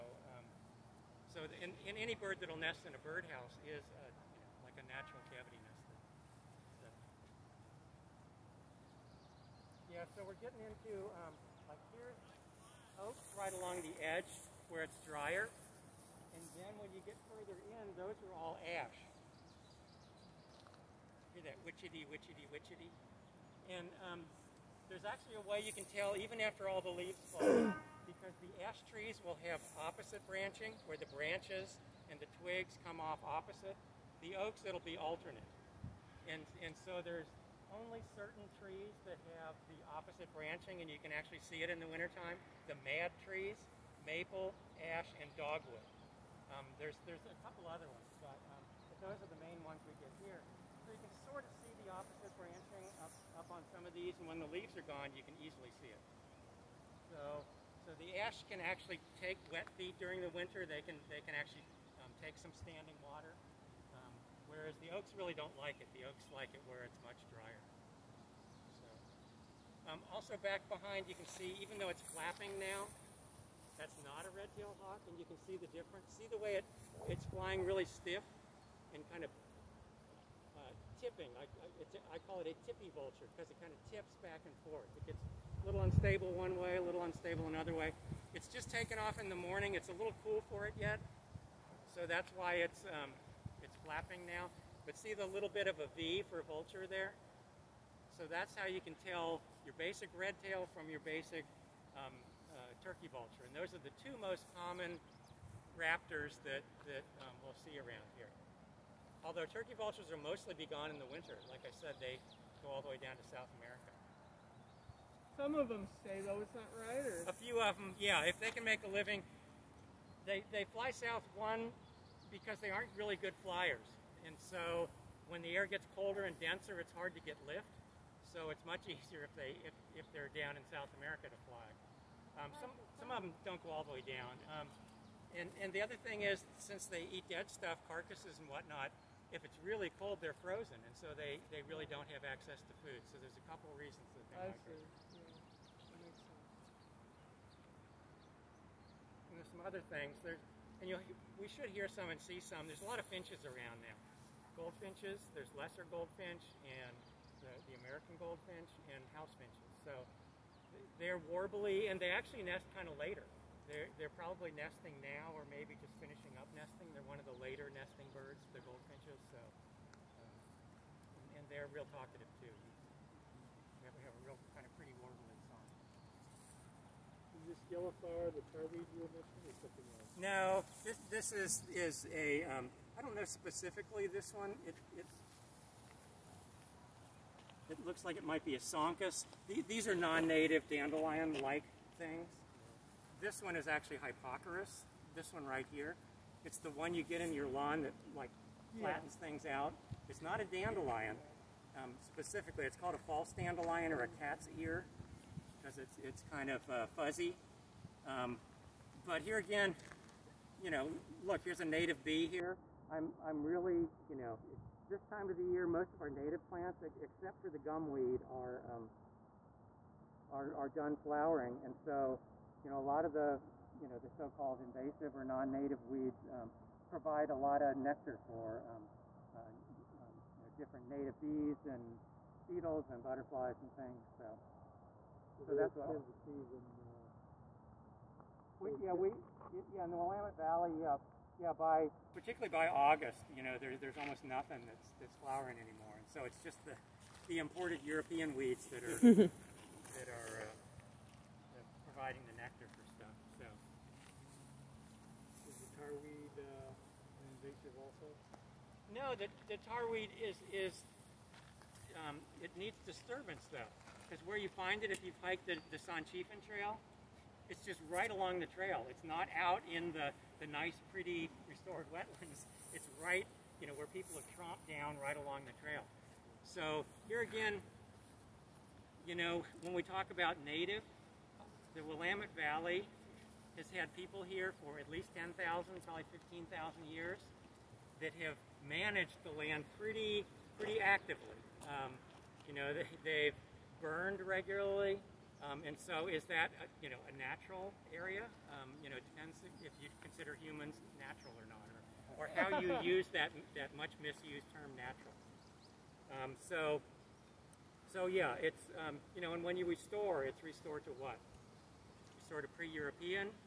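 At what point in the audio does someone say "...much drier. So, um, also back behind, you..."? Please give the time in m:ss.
1:07.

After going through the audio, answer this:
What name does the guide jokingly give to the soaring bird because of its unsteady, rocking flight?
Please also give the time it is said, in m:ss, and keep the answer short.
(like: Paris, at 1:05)
Tippy vulture, at 1:22.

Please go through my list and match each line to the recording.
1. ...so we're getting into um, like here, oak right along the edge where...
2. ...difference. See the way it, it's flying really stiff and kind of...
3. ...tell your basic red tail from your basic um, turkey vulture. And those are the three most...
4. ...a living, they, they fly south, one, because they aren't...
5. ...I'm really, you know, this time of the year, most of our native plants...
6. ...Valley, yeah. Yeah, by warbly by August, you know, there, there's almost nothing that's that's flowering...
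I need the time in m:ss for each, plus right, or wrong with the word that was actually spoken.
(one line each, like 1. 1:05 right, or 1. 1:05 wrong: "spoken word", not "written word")
1. 0:10 right
2. 1:15 right
3. 1:39 wrong: "two", not "three"
4. 1:58 right
5. 3:33 right
6. 4:00 wrong: "particularly", not "warbly".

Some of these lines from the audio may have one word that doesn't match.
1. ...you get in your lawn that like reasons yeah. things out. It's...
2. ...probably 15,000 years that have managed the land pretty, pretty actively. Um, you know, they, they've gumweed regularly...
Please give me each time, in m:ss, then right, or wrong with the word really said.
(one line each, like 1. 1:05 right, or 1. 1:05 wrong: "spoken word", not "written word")
1. 3:16 wrong: "flattens", not "reasons"
2. 4:45 wrong: "burned", not "gumweed".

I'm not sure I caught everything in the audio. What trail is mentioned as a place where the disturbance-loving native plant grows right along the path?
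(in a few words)
Sanchifan Trail.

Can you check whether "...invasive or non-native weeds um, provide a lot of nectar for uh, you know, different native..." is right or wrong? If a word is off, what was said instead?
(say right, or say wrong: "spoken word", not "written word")
right.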